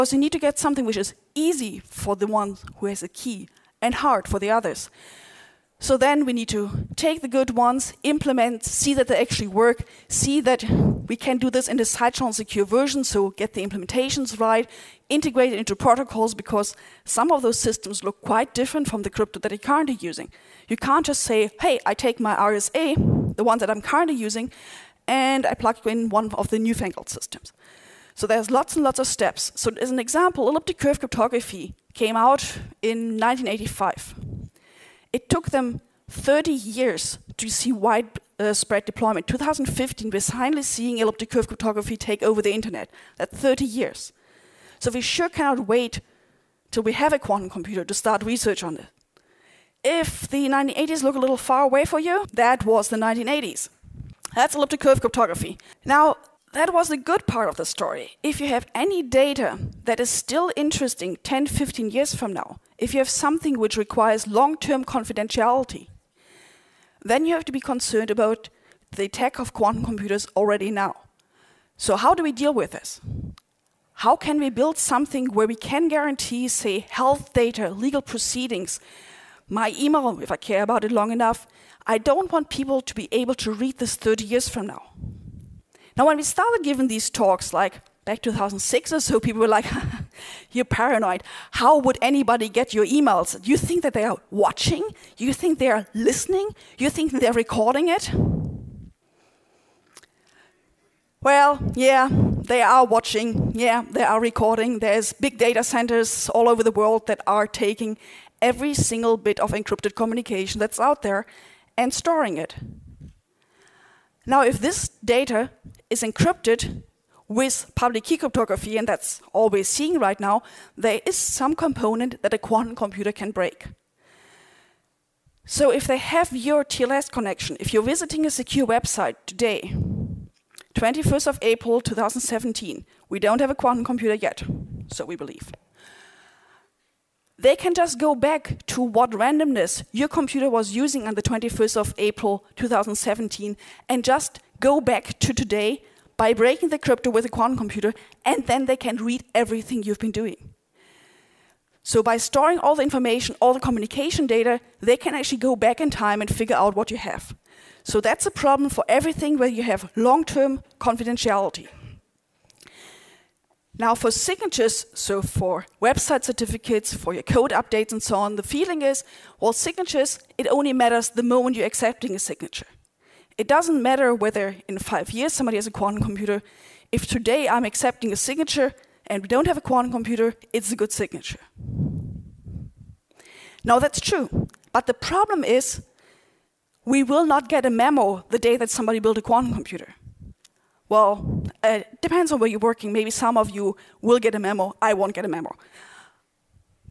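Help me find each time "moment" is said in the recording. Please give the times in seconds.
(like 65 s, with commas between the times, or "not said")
171 s.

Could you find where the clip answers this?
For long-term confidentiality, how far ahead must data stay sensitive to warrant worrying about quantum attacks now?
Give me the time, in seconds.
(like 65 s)
61 s.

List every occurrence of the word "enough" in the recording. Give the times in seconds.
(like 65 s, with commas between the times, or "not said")
81 s.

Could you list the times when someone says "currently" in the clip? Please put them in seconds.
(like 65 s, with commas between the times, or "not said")
19 s, 23 s.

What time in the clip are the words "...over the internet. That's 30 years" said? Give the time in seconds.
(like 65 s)
42 s.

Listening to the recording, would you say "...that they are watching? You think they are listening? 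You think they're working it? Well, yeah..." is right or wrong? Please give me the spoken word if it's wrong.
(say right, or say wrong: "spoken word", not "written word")
wrong: "recording", not "working".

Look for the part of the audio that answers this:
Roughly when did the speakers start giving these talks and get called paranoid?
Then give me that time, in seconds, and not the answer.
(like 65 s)
88 s.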